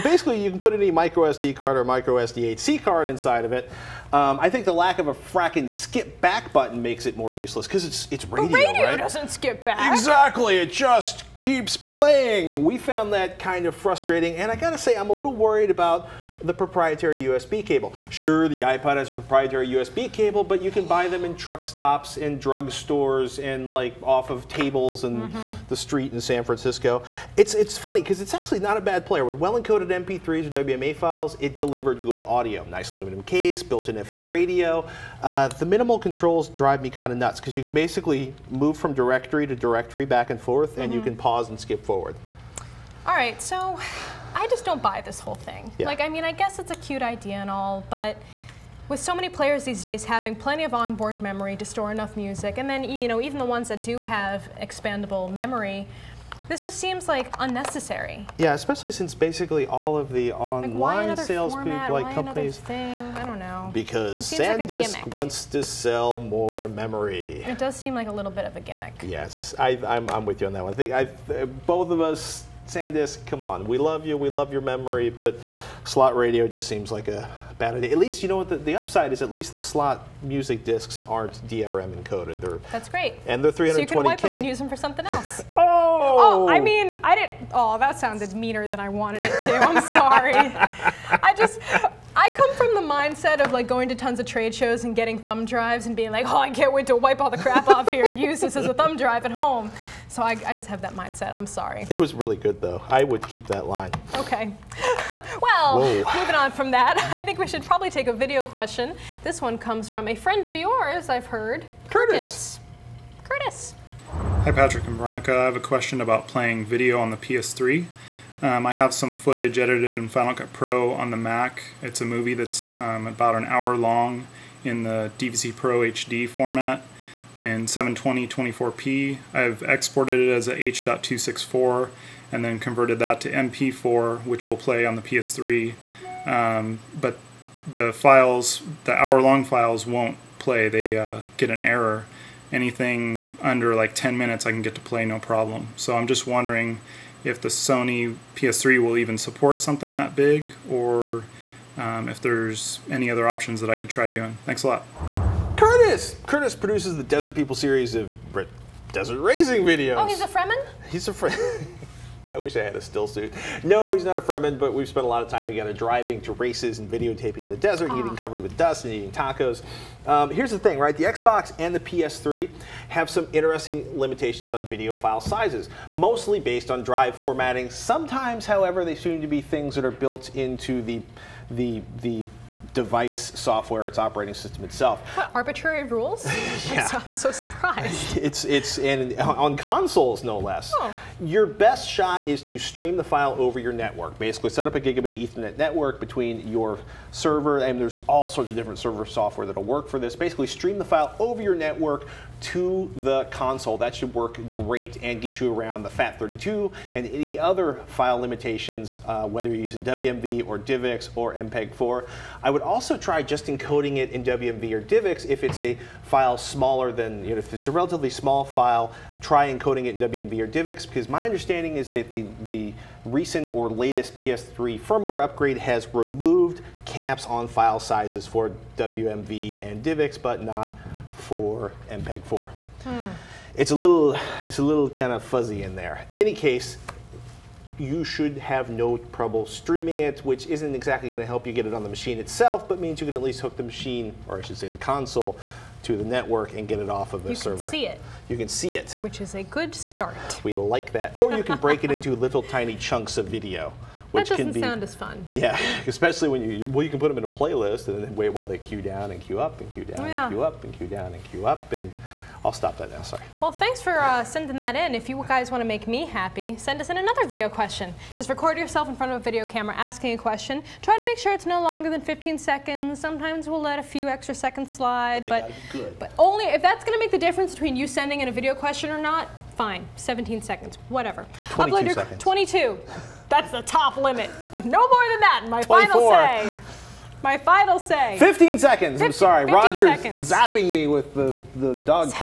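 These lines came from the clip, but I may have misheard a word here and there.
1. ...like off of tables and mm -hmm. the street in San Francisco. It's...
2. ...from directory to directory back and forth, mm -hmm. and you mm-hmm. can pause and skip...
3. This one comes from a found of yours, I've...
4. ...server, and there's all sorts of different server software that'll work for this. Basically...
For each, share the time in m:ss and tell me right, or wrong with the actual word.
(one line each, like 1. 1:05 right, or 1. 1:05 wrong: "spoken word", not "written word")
1. 0:23 right
2. 0:38 right
3. 1:49 wrong: "friend", not "found"
4. 3:17 right.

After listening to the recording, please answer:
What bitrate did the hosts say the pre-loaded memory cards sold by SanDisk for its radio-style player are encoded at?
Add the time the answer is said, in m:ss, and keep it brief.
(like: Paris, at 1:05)
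320k, at 1:23.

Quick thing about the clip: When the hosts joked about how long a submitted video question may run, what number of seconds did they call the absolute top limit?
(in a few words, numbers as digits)
22.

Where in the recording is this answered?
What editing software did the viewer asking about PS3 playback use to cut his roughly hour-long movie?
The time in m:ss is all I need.
2:00.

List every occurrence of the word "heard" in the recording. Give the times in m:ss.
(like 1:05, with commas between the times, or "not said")
1:51.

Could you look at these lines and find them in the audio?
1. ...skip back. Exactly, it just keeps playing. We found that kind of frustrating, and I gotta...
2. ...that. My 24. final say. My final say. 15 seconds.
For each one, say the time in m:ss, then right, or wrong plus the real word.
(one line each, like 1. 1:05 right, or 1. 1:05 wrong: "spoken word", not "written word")
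1. 0:09 right
2. 4:45 right.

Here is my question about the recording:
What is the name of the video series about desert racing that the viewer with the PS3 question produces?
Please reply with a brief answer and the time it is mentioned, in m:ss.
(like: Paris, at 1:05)
Desert People, at 2:37.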